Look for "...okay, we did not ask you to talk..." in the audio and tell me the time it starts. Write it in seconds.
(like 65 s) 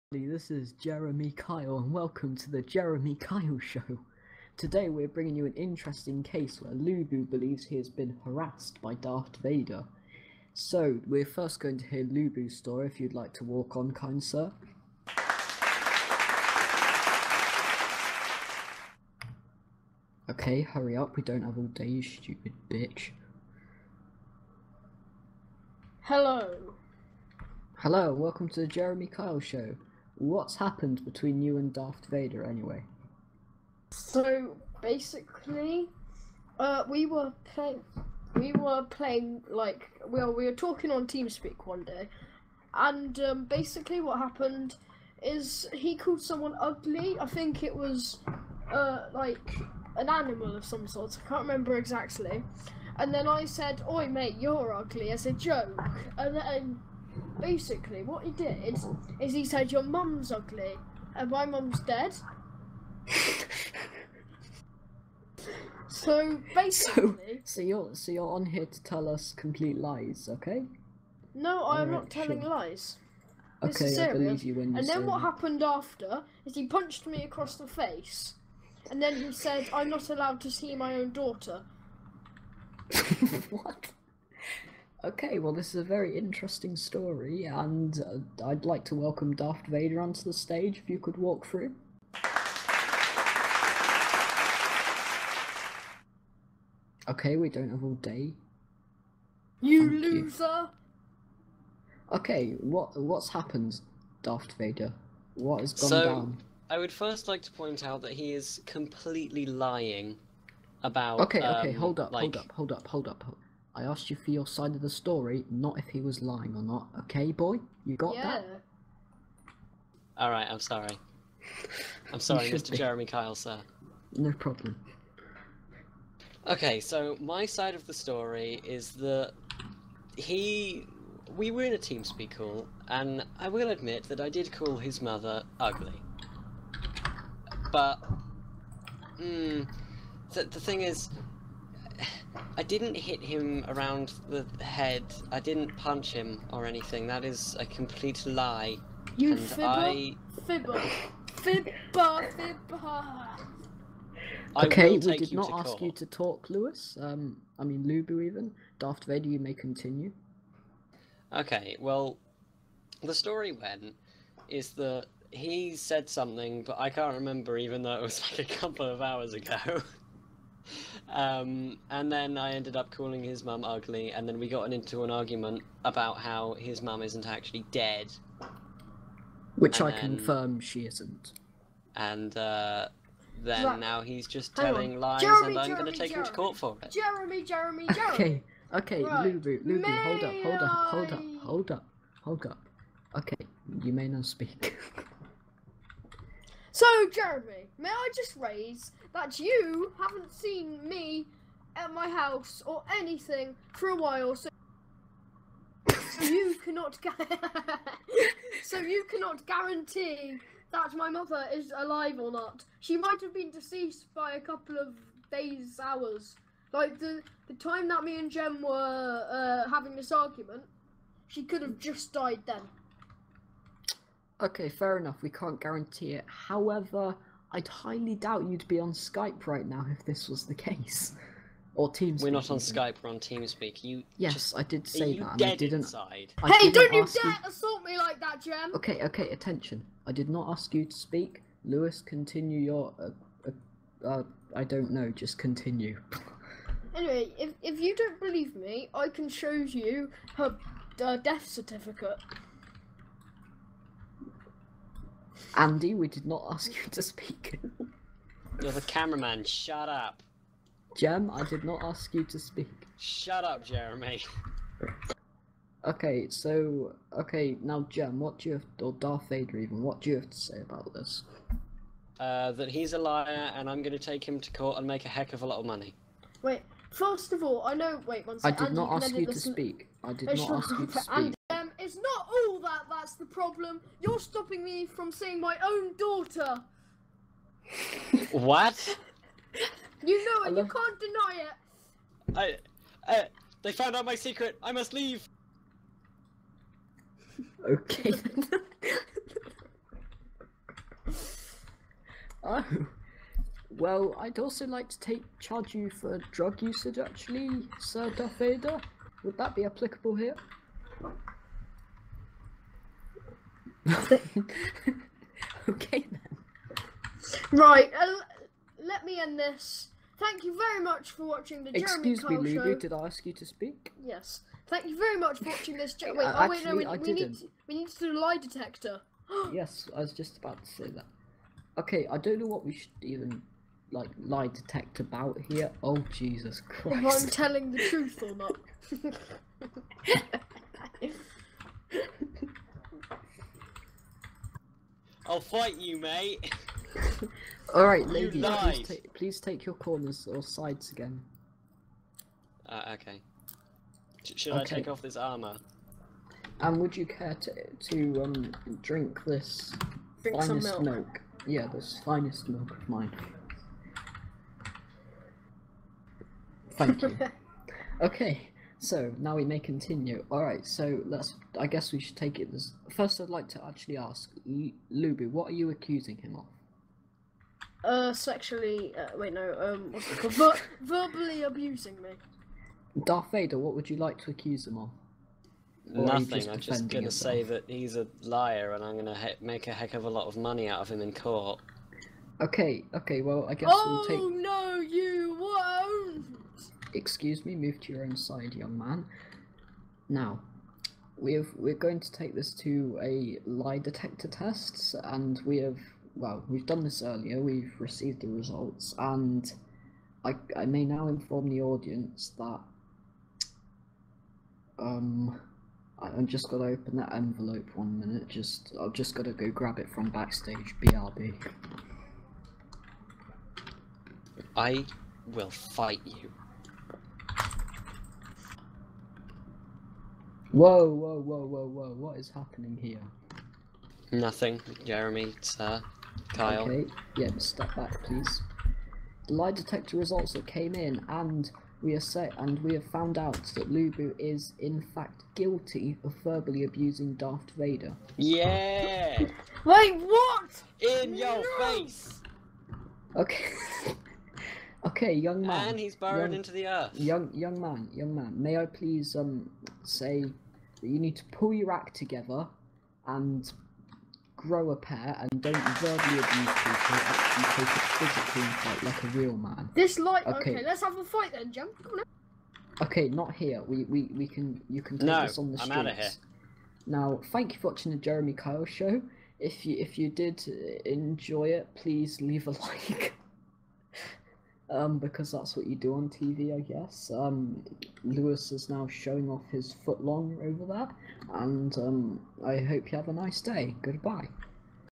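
154 s.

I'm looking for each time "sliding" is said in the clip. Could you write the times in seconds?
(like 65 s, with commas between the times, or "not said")
not said.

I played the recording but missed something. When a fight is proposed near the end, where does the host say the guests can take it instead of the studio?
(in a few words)
On the streets.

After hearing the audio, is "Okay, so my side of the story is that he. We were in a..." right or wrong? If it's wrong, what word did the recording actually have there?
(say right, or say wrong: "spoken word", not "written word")
right.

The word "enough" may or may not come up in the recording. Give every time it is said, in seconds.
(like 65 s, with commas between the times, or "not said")
224 s.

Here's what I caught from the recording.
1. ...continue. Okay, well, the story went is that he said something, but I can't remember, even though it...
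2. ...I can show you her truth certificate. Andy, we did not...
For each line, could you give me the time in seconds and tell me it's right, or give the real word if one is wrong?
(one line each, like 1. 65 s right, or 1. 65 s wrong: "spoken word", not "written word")
1. 159 s right
2. 248 s wrong: "death", not "truth".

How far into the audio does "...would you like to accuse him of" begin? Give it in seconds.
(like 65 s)
383 s.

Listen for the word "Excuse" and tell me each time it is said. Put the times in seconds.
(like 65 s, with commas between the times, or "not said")
322 s, 396 s.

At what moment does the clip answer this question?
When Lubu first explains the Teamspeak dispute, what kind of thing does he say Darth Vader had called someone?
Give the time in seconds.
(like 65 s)
49 s.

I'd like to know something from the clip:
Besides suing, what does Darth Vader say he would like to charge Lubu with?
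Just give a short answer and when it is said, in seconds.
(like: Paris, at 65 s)
Drug usage, at 306 s.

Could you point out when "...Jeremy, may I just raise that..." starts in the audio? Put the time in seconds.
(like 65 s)
197 s.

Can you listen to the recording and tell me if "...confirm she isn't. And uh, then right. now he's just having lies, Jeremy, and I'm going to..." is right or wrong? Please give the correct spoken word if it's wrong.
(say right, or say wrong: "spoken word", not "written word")
wrong: "telling", not "having".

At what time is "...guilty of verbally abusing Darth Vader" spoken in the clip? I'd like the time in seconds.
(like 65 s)
445 s.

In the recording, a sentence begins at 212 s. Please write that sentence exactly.
She might have been deceased by a couple of days, hours.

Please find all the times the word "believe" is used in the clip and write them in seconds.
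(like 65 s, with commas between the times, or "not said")
7 s, 74 s, 248 s.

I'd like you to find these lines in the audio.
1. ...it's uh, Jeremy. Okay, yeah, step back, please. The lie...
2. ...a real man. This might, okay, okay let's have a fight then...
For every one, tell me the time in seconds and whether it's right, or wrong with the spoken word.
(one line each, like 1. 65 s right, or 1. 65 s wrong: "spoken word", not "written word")
1. 435 s wrong: "Kyle", not "Jeremy"
2. 469 s wrong: "light", not "might".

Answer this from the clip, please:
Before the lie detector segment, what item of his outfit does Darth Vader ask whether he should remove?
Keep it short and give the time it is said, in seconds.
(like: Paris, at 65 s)
Armor, at 355 s.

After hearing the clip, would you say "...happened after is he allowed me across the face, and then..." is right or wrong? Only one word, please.
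wrong.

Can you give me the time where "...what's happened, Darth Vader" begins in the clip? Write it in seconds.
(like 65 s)
102 s.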